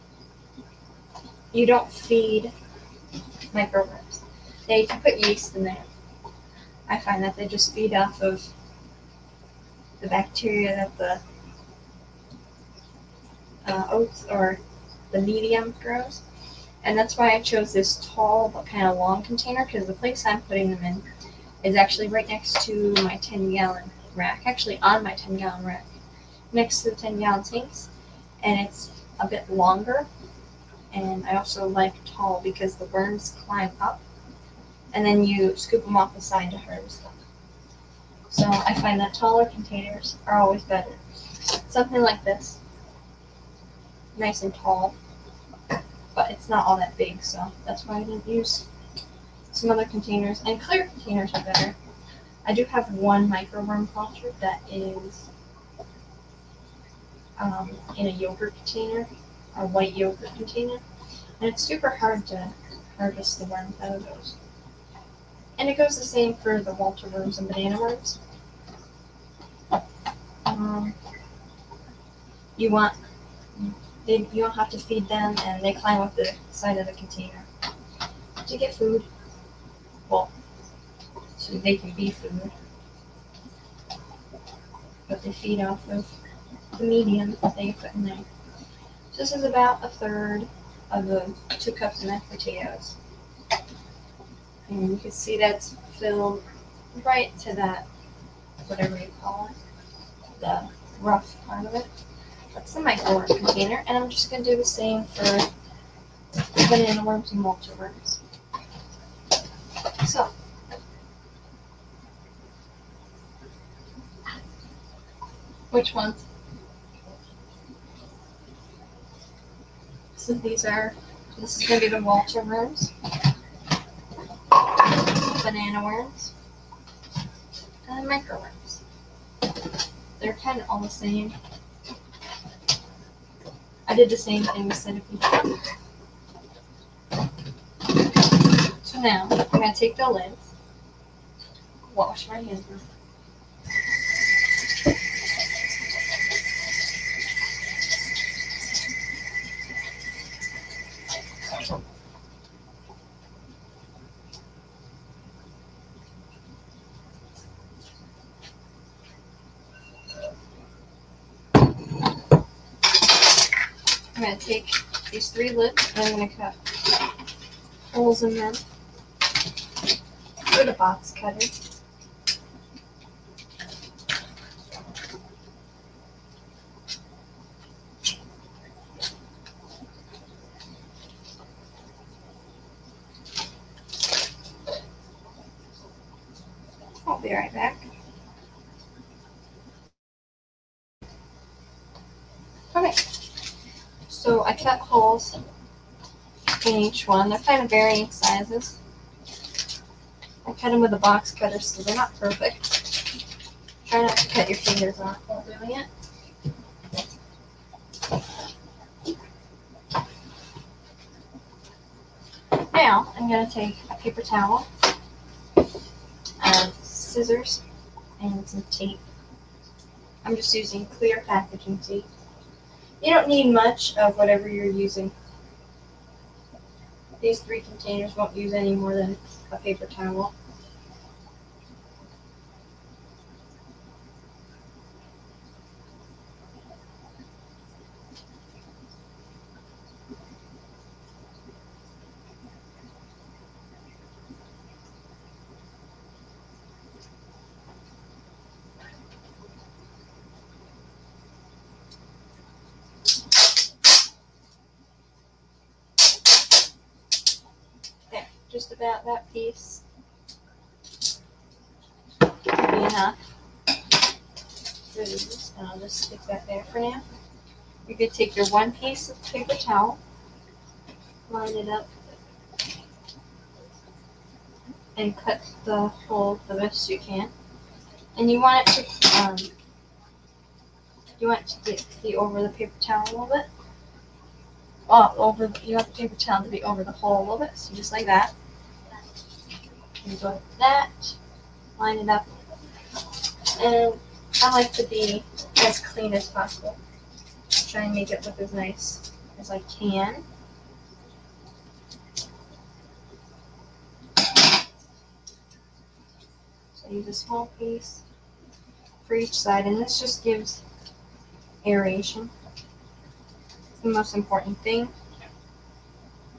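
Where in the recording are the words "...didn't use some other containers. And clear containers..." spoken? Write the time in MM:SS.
00:48.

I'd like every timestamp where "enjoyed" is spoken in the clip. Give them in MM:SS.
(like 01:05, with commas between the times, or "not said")
not said.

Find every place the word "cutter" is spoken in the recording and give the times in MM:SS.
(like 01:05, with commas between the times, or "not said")
02:51, 03:21.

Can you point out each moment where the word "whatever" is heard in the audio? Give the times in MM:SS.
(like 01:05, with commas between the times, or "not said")
01:38, 03:44.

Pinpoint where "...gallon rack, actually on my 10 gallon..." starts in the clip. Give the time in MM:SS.
00:23.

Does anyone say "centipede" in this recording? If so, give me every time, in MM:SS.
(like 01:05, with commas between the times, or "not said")
02:14.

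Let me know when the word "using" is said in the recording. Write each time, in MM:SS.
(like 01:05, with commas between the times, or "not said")
03:40, 03:44.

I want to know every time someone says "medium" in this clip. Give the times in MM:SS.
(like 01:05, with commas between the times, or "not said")
00:15, 01:26.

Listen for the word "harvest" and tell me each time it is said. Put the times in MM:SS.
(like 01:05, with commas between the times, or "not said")
00:36, 01:02.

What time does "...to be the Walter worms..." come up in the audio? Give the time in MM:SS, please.
02:01.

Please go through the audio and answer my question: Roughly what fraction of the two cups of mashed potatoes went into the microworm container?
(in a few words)
a third.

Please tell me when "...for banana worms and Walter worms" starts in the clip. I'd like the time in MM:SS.
01:45.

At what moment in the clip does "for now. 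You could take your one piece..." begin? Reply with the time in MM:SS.
04:26.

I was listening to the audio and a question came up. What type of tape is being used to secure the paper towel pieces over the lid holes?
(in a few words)
clear packaging tape.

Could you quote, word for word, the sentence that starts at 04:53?
And I like to be as clean as possible.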